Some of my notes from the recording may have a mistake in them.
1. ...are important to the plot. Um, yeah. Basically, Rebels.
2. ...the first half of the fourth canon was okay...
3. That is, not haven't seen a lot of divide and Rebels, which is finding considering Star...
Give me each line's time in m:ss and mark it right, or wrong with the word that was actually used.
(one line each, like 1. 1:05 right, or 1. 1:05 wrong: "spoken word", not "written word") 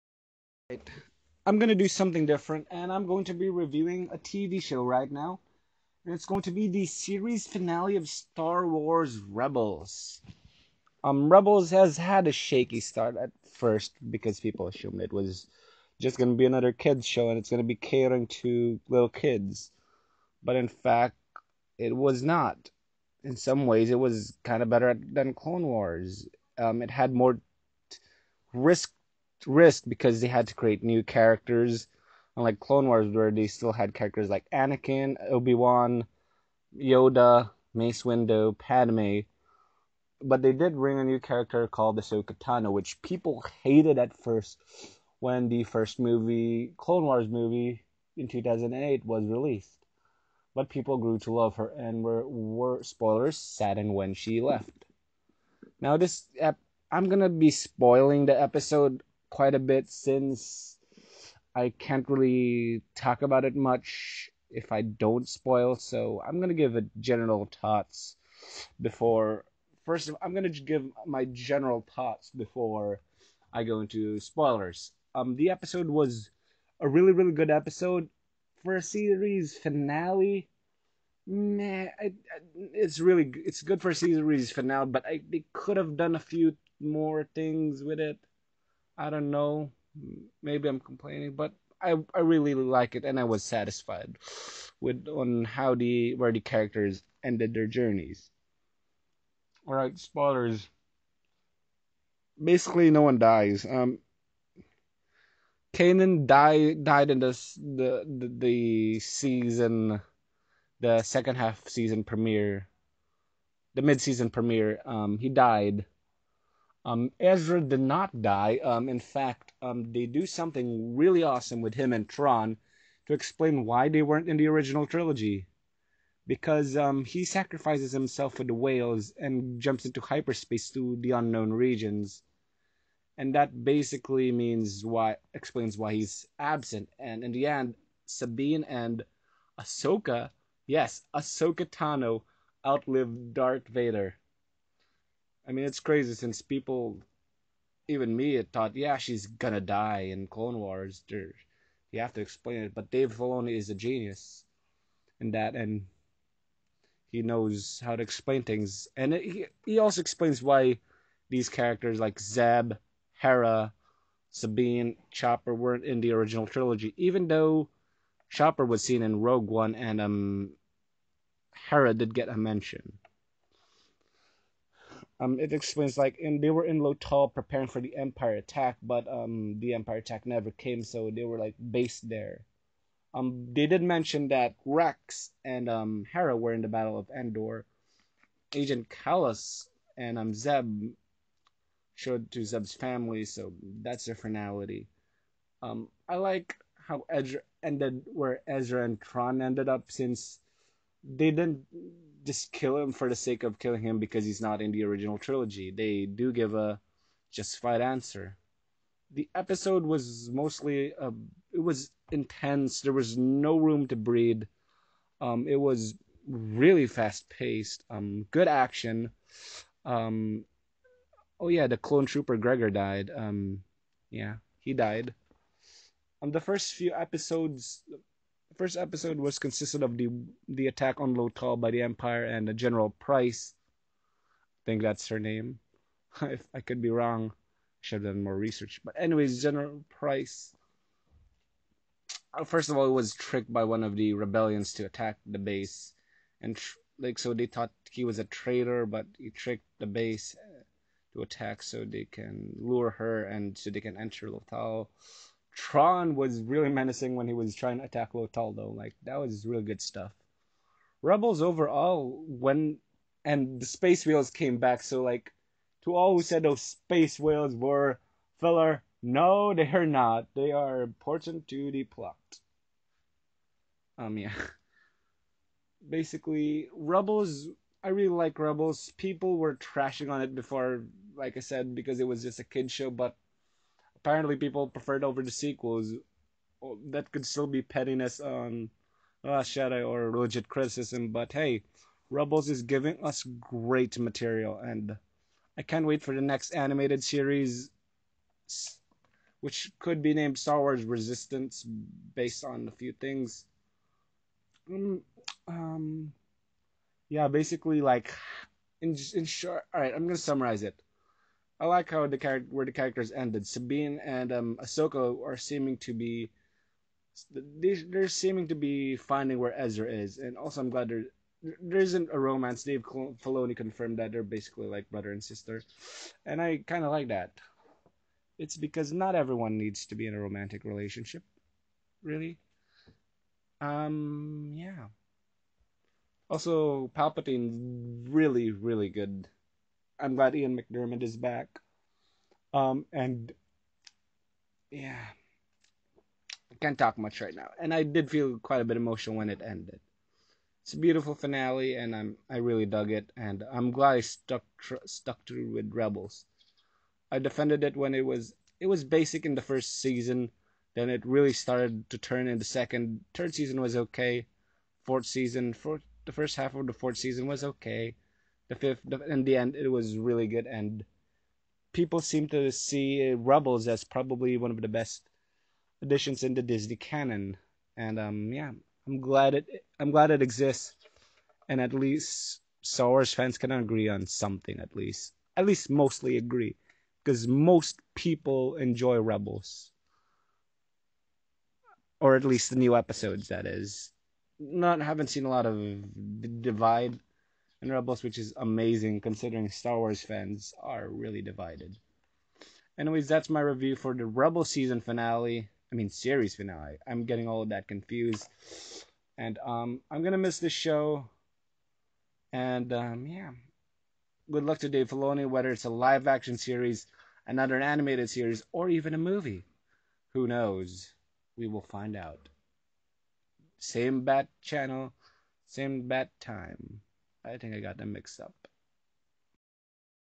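1. 4:30 right
2. 6:06 wrong: "season", not "canon"
3. 6:33 wrong: "amazing", not "finding".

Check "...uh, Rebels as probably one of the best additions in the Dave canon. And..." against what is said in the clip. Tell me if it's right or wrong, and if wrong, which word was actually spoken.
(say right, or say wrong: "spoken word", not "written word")
wrong: "Disney", not "Dave".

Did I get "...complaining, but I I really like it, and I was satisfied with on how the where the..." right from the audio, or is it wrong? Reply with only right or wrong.
right.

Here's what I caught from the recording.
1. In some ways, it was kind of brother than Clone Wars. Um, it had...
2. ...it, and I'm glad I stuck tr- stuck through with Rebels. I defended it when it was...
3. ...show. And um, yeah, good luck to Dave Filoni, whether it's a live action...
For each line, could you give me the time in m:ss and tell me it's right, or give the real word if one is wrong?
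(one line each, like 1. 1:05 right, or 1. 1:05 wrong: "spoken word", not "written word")
1. 0:23 wrong: "better", not "brother"
2. 5:52 right
3. 6:50 right.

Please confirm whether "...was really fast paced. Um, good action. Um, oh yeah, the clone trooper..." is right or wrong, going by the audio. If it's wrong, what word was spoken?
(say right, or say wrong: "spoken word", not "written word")
right.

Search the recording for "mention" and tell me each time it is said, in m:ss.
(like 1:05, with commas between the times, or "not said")
2:52, 3:03.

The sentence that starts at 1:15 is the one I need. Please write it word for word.
Um, the episode was a really really good episode for a series finale.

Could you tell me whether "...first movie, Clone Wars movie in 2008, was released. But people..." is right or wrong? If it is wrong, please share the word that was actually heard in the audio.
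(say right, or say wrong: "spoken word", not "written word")
right.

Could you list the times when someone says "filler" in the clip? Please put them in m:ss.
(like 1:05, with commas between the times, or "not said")
4:28.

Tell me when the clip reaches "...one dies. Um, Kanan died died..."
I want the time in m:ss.
1:43.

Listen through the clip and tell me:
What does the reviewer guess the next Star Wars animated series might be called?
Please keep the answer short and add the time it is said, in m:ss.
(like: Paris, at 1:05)
Star Wars Resistance, at 5:00.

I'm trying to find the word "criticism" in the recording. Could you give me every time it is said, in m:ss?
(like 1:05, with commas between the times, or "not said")
4:50.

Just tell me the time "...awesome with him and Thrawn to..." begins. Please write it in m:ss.
2:01.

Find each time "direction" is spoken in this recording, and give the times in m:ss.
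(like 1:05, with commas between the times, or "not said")
not said.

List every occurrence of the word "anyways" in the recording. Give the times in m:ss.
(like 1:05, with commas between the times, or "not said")
3:58, 6:42.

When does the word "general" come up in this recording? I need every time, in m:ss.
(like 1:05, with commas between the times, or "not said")
1:06, 1:11, 3:52, 3:59.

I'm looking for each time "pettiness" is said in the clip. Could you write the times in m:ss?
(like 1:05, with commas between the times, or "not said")
4:47.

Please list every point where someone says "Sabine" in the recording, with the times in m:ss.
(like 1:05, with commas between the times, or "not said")
2:18, 2:44, 5:13.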